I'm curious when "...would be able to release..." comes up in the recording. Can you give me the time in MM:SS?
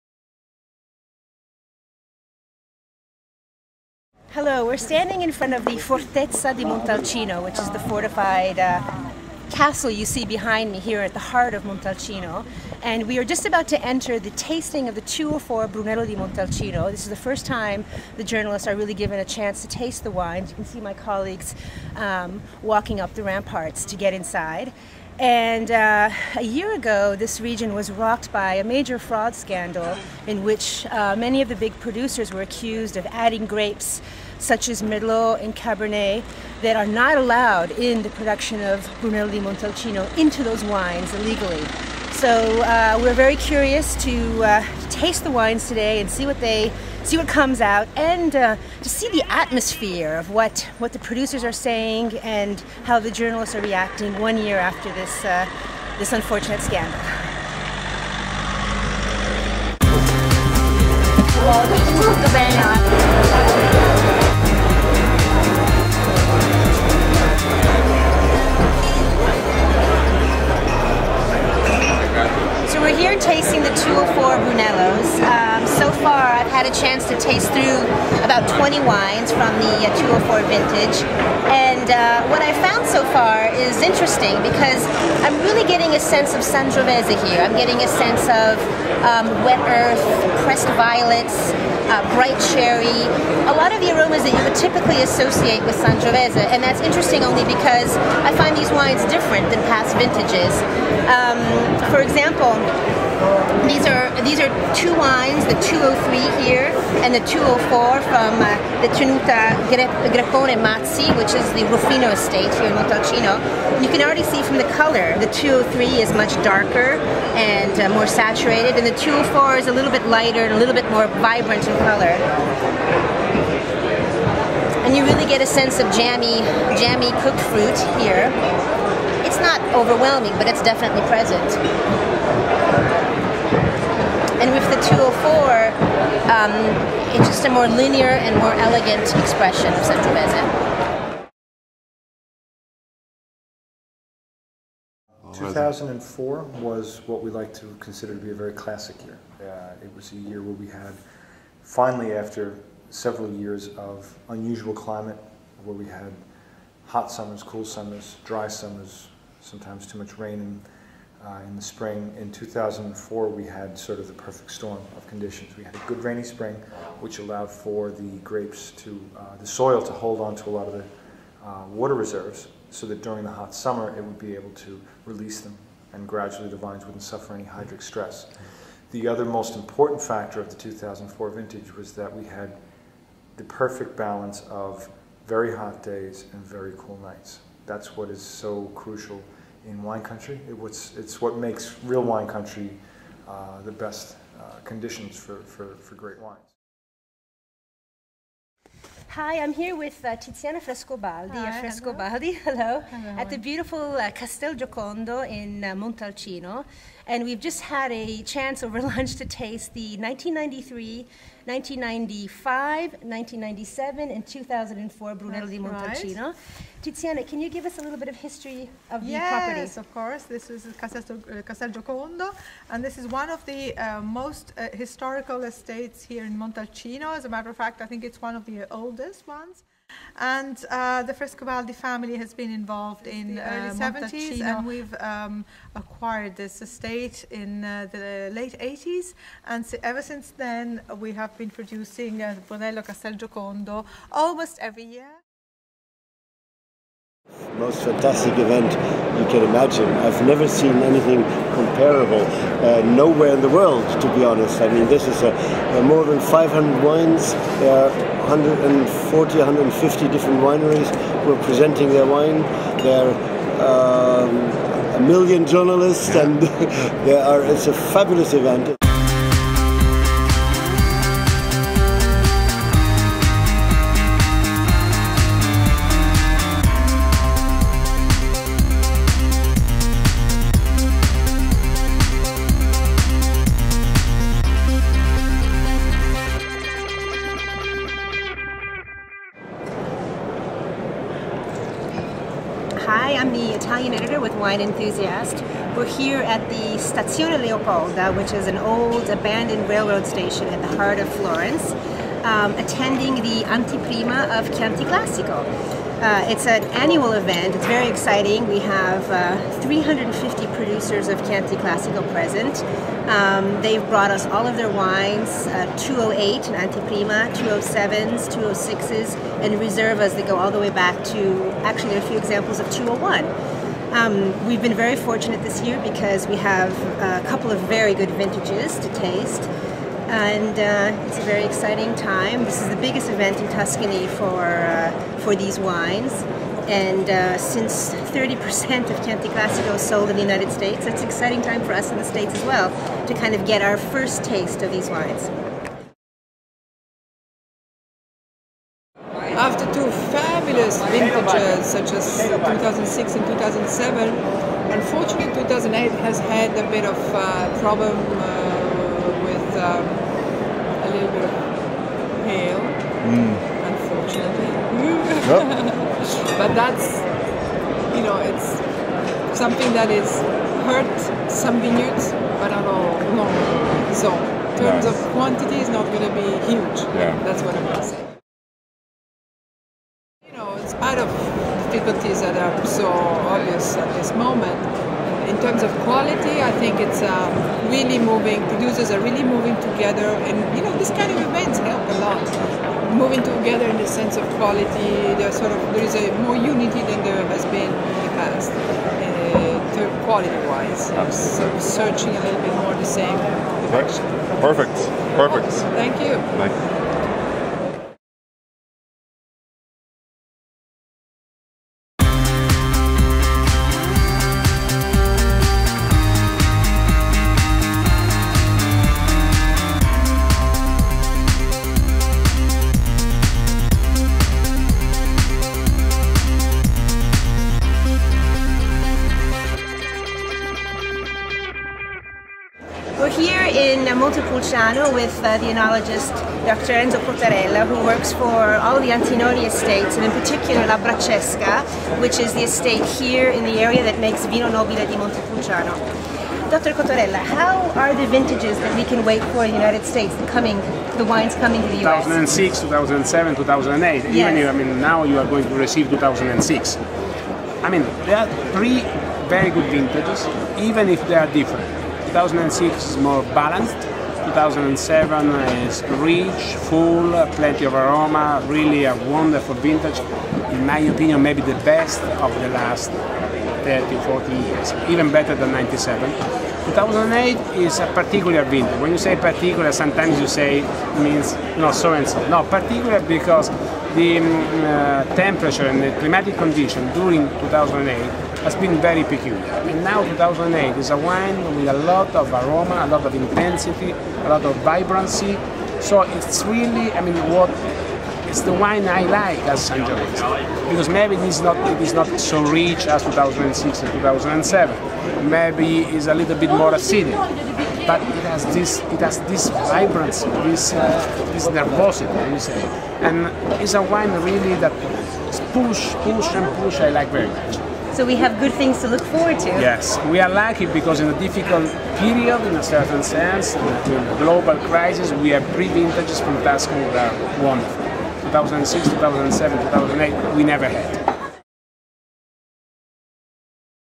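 02:54.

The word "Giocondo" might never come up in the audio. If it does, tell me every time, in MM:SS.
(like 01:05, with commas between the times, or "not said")
03:24, 03:41, 04:03.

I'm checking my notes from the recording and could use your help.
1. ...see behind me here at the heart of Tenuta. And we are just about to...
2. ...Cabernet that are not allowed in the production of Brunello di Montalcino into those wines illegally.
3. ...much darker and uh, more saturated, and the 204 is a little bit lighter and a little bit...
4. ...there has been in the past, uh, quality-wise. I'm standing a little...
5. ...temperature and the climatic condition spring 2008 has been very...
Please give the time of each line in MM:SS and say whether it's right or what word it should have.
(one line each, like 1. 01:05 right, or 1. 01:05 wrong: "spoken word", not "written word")
1. 00:10 wrong: "Montalcino", not "Tenuta"
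2. 00:35 right
3. 01:56 right
4. 06:37 wrong: "searching", not "standing"
5. 08:05 wrong: "during", not "spring".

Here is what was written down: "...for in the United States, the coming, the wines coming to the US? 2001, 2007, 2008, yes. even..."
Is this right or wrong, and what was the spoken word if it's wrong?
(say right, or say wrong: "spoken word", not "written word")
wrong: "2006", not "2001".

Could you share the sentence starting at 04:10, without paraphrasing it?
I've never seen anything comparable uh, nowhere in the world, to be honest.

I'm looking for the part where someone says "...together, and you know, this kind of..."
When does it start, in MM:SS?
06:29.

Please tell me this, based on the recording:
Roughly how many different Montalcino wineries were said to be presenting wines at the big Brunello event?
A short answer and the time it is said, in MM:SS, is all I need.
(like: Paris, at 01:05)
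140-150, at 04:18.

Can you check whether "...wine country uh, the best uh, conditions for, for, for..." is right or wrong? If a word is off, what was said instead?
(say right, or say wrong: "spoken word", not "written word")
right.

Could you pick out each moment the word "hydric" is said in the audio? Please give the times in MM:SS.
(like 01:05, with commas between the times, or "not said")
02:57.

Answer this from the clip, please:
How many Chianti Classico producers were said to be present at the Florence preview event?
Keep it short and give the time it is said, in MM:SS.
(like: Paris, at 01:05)
350, at 05:09.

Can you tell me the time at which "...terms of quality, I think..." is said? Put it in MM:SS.
06:25.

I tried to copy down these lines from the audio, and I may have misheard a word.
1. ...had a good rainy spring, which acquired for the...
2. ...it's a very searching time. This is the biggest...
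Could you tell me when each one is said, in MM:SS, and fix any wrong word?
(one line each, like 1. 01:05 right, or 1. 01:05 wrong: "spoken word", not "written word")
1. 02:45 wrong: "allowed", not "acquired"
2. 05:31 wrong: "exciting", not "searching".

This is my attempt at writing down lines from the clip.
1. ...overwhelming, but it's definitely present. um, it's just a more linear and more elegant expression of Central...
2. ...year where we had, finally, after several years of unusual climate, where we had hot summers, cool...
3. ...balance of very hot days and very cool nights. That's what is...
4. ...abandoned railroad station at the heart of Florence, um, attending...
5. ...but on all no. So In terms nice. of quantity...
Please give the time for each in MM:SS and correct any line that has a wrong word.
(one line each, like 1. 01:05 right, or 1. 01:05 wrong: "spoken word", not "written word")
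1. 02:09 right
2. 02:30 right
3. 03:03 right
4. 04:59 right
5. 06:12 right.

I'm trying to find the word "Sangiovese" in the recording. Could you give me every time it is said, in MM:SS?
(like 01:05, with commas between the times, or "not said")
01:26, 01:35, 08:19.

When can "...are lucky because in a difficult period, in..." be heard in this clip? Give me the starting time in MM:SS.
08:40.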